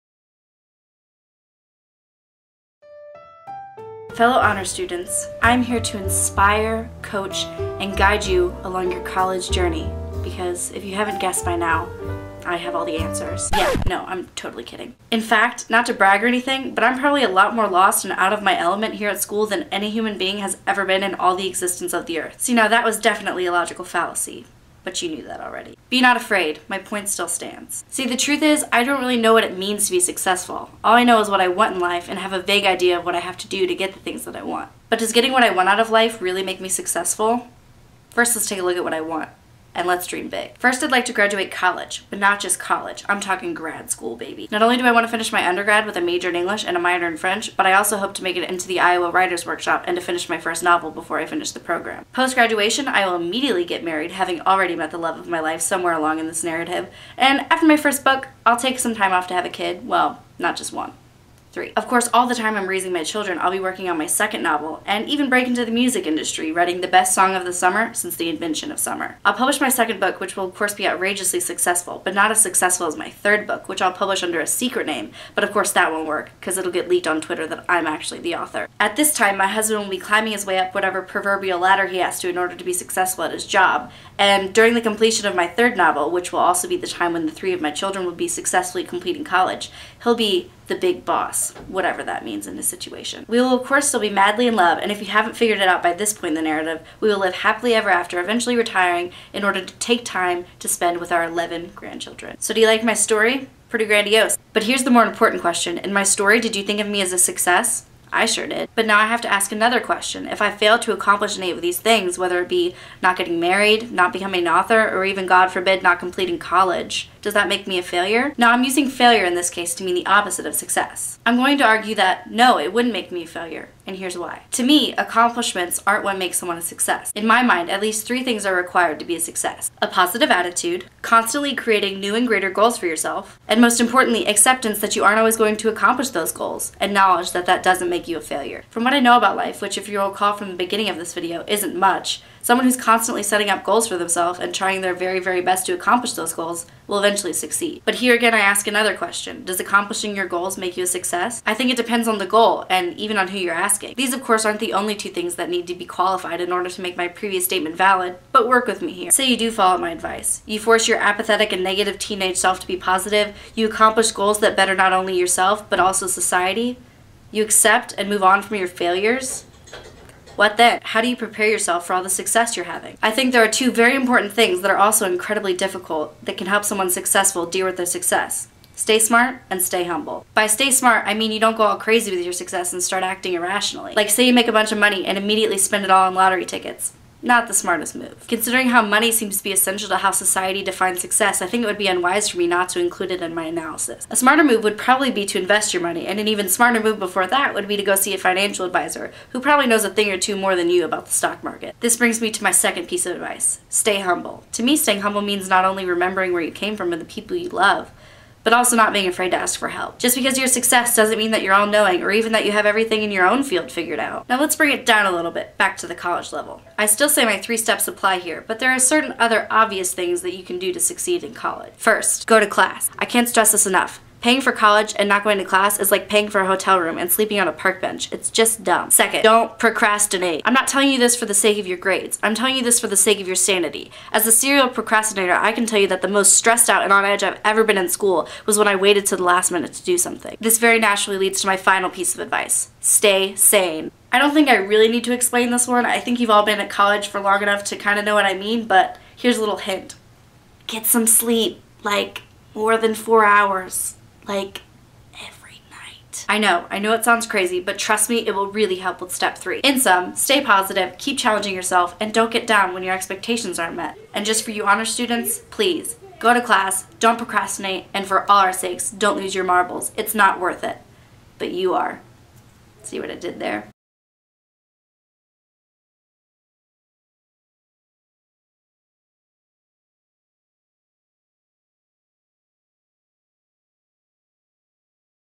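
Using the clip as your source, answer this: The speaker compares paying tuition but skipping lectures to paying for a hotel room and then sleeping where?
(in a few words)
A park bench.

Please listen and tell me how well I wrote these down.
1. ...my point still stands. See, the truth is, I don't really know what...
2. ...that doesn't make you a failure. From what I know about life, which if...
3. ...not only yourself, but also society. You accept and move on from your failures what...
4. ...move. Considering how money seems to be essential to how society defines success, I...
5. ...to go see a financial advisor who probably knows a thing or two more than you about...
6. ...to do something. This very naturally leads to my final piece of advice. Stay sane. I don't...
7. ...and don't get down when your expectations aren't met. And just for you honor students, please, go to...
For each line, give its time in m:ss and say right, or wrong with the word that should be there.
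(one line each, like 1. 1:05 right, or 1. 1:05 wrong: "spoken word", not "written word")
1. 0:26 right
2. 2:17 right
3. 2:44 right
4. 3:07 right
5. 3:17 right
6. 3:59 right
7. 4:21 right.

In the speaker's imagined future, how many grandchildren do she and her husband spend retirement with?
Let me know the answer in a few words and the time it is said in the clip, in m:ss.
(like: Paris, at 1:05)
11, at 1:41.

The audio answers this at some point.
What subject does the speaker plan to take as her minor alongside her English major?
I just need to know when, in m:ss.
0:47.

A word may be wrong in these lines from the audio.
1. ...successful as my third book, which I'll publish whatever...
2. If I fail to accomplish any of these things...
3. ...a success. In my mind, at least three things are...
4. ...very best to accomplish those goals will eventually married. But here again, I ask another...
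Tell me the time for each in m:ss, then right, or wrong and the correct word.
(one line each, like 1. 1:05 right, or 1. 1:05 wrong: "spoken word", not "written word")
1. 1:12 wrong: "under", not "whatever"
2. 1:50 right
3. 2:06 right
4. 2:25 wrong: "succeed", not "married".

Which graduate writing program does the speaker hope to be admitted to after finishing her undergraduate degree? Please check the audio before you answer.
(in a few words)
Iowa Writers Workshop.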